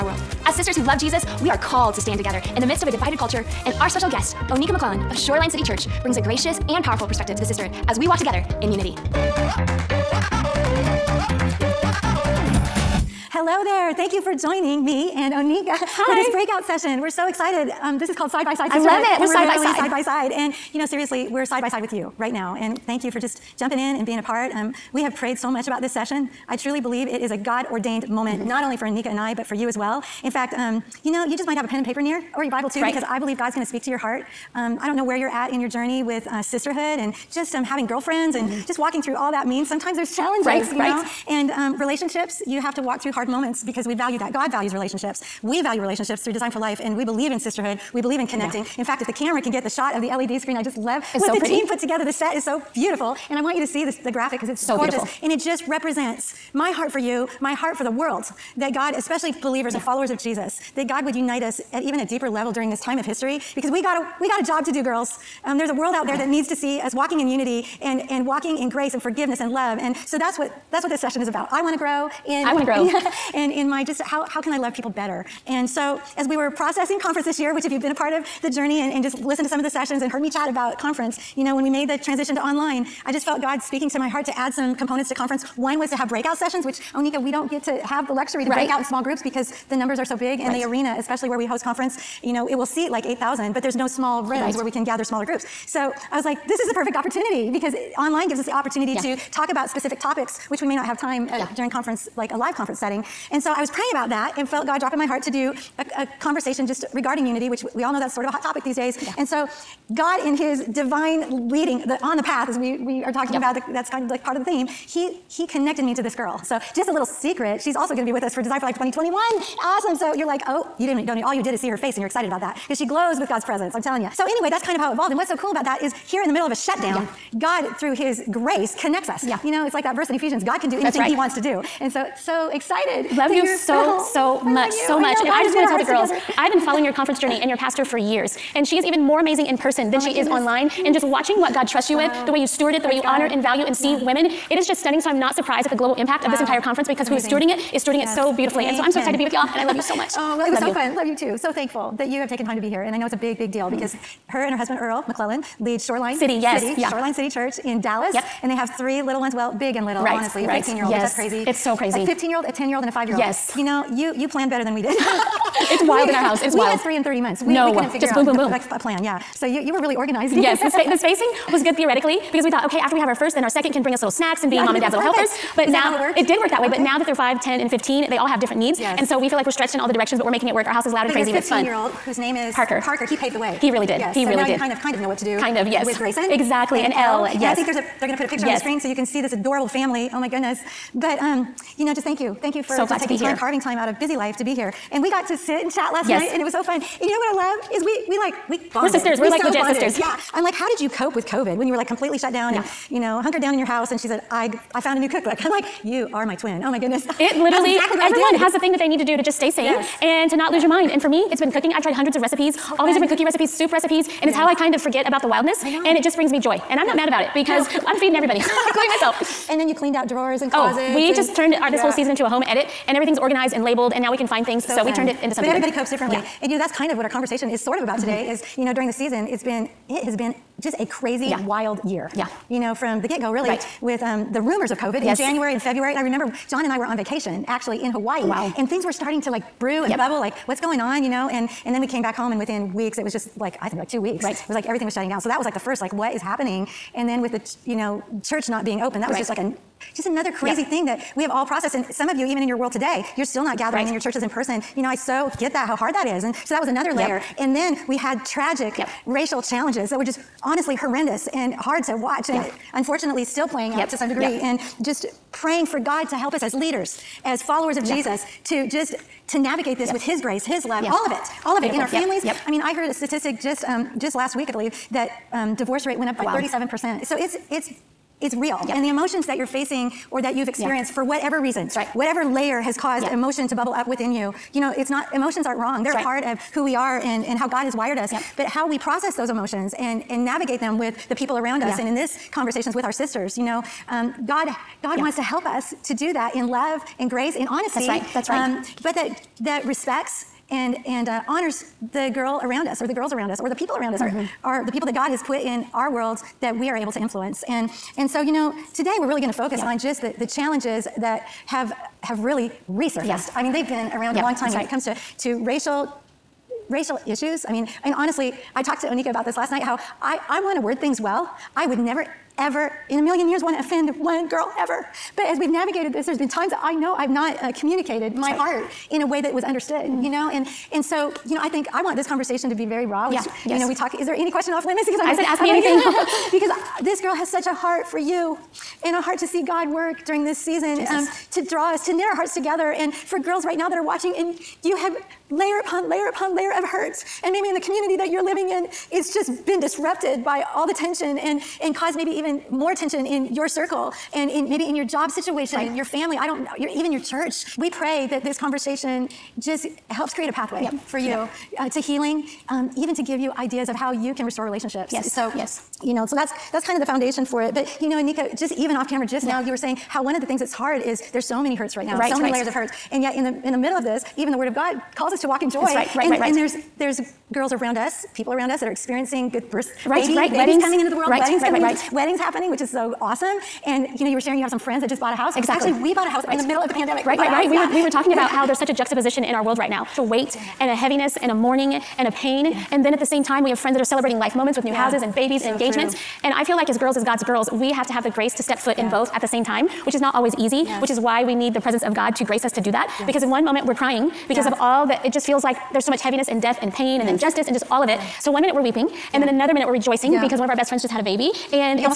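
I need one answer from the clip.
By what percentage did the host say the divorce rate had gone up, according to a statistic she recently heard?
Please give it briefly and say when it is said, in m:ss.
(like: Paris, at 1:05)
37%, at 4:36.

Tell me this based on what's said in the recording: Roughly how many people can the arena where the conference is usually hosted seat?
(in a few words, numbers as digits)
8,000.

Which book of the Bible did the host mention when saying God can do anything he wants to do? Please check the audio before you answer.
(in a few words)
Ephesians.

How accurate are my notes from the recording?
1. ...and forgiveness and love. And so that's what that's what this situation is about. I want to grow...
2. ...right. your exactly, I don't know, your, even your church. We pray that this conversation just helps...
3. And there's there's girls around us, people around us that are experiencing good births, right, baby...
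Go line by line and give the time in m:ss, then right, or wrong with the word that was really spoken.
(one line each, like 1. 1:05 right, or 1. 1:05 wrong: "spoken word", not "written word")
1. 1:08 wrong: "session", not "situation"
2. 5:55 wrong: "family", not "exactly"
3. 6:16 right.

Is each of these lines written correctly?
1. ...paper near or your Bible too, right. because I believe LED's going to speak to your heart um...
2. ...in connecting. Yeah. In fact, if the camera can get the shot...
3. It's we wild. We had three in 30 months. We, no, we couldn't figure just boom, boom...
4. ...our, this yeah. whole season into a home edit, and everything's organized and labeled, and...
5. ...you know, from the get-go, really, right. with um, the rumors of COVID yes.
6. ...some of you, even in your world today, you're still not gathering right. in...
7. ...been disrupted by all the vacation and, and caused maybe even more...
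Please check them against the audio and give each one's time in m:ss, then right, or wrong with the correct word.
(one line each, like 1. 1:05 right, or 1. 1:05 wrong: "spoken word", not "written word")
1. 0:31 wrong: "God", not "LED"
2. 0:48 right
3. 2:46 right
4. 3:41 right
5. 3:52 right
6. 4:11 right
7. 5:49 wrong: "tension", not "vacation".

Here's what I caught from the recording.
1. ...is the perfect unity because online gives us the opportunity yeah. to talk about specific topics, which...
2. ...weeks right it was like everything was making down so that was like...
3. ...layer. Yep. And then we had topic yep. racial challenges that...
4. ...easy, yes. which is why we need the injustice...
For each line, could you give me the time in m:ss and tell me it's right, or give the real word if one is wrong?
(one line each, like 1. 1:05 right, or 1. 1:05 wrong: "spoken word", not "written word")
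1. 1:36 wrong: "opportunity", not "unity"
2. 4:04 wrong: "shutting", not "making"
3. 4:16 wrong: "tragic", not "topic"
4. 6:40 wrong: "presence", not "injustice".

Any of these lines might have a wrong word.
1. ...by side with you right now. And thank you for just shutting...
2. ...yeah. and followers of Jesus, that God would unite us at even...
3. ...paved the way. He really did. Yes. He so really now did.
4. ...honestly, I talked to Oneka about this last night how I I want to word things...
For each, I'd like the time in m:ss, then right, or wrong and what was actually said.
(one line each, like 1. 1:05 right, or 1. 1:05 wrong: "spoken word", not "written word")
1. 0:21 wrong: "jumping", not "shutting"
2. 0:59 right
3. 3:03 right
4. 5:17 right.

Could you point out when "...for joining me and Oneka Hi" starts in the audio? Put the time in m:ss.
0:14.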